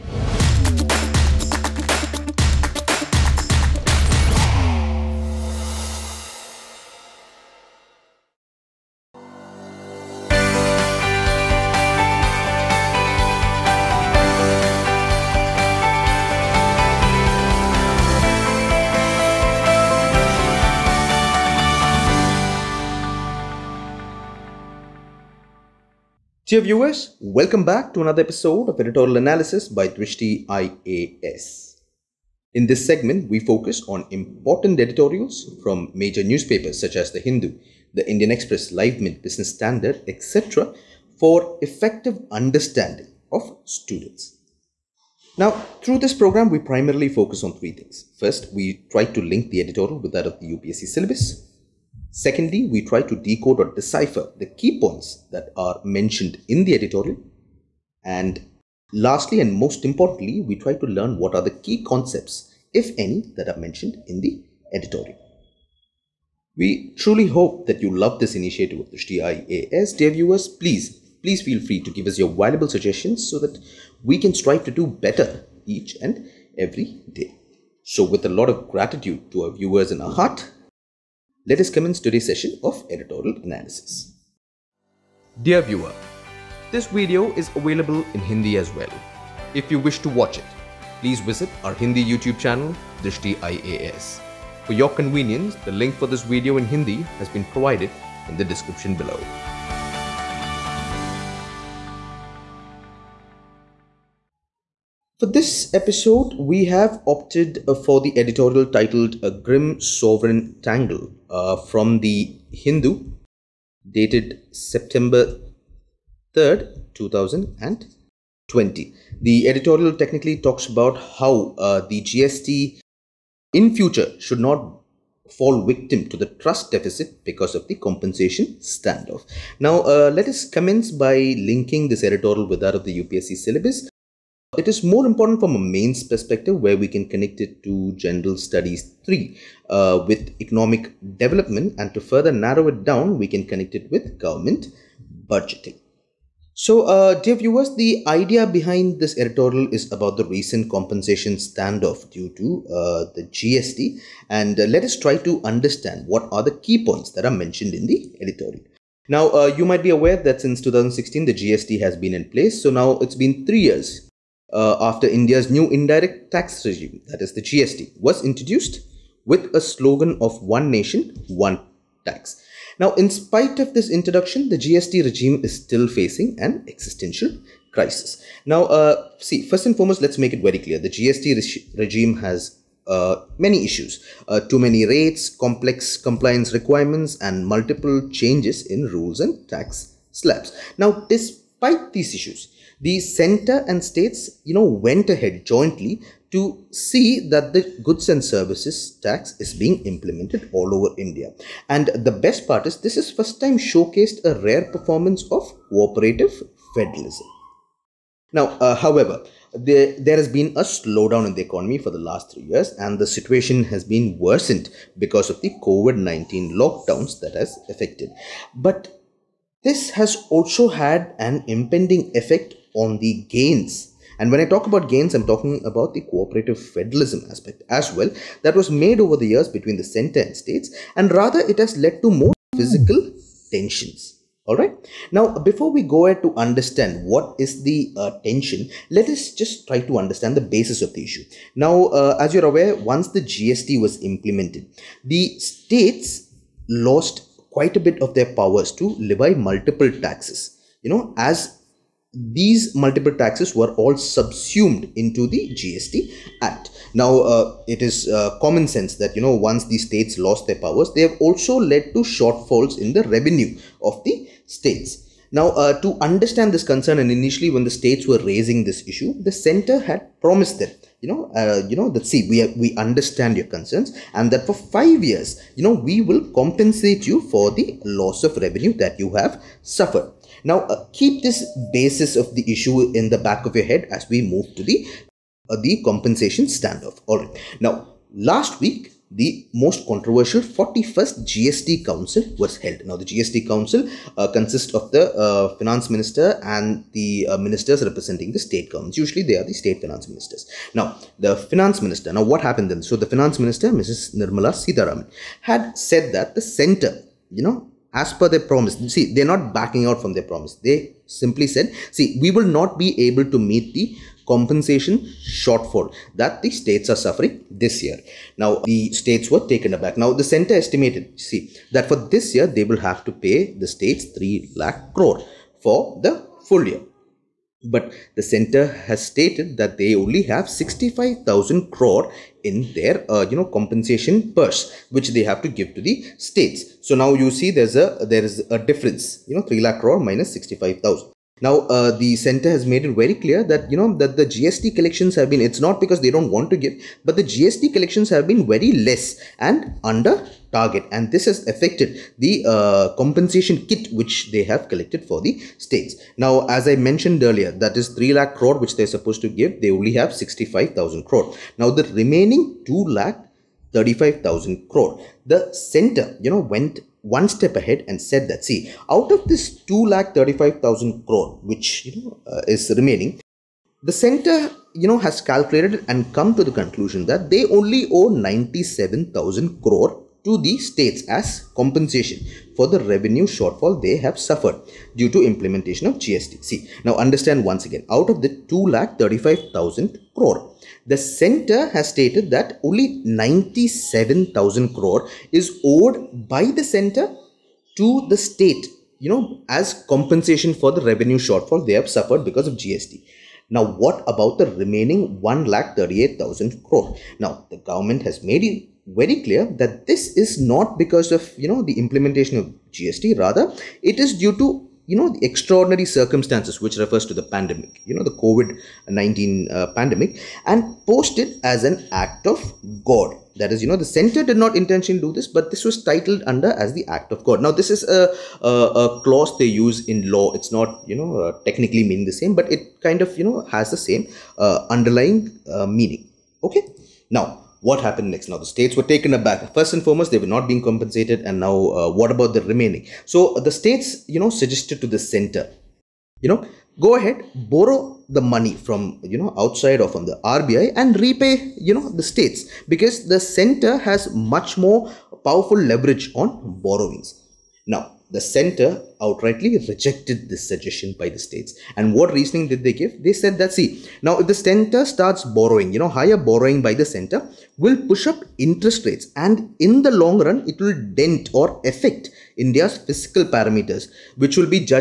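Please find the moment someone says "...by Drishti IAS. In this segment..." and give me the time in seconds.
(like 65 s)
29 s.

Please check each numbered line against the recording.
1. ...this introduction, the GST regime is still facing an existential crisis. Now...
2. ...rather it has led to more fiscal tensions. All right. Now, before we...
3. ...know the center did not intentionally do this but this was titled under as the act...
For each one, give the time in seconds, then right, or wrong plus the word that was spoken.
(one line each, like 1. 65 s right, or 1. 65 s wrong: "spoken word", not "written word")
1. 173 s right
2. 231 s right
3. 423 s right.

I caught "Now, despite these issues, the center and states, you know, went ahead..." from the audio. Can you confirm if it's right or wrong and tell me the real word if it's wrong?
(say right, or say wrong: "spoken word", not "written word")
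right.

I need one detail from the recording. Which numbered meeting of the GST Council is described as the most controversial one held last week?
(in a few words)
41st.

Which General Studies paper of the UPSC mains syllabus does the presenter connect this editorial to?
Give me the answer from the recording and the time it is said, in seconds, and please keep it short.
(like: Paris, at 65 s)
General Studies 3, at 137 s.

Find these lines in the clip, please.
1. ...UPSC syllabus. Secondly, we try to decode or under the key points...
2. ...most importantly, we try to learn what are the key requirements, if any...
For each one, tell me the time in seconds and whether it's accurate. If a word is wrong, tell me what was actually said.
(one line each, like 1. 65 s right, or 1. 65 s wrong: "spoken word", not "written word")
1. 50 s wrong: "decipher", not "under"
2. 59 s wrong: "concepts", not "requirements".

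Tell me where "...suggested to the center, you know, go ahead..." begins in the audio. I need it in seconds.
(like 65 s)
444 s.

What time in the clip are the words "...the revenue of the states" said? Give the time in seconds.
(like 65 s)
262 s.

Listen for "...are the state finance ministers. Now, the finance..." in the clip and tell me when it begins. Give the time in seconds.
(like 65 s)
299 s.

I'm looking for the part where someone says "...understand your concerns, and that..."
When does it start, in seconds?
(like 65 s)
272 s.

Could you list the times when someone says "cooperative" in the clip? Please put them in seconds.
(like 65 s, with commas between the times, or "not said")
205 s, 226 s.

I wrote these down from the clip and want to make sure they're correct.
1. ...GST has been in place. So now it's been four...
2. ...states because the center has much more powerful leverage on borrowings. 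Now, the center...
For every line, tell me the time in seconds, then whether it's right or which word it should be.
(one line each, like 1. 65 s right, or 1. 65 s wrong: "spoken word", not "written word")
1. 161 s wrong: "three", not "four"
2. 452 s right.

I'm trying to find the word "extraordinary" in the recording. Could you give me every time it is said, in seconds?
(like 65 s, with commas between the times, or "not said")
415 s.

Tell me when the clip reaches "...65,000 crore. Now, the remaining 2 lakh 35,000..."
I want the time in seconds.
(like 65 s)
360 s.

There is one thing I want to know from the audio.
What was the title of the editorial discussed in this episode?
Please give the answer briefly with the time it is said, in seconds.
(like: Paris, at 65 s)
A Grim Sovereign Tangle, at 109 s.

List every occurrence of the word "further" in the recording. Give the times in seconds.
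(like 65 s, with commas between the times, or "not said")
141 s.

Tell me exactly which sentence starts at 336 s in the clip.
So now you see there's a there is a difference you know 3 lakh crore minus 65,000.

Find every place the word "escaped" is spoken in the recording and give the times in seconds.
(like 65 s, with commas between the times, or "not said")
not said.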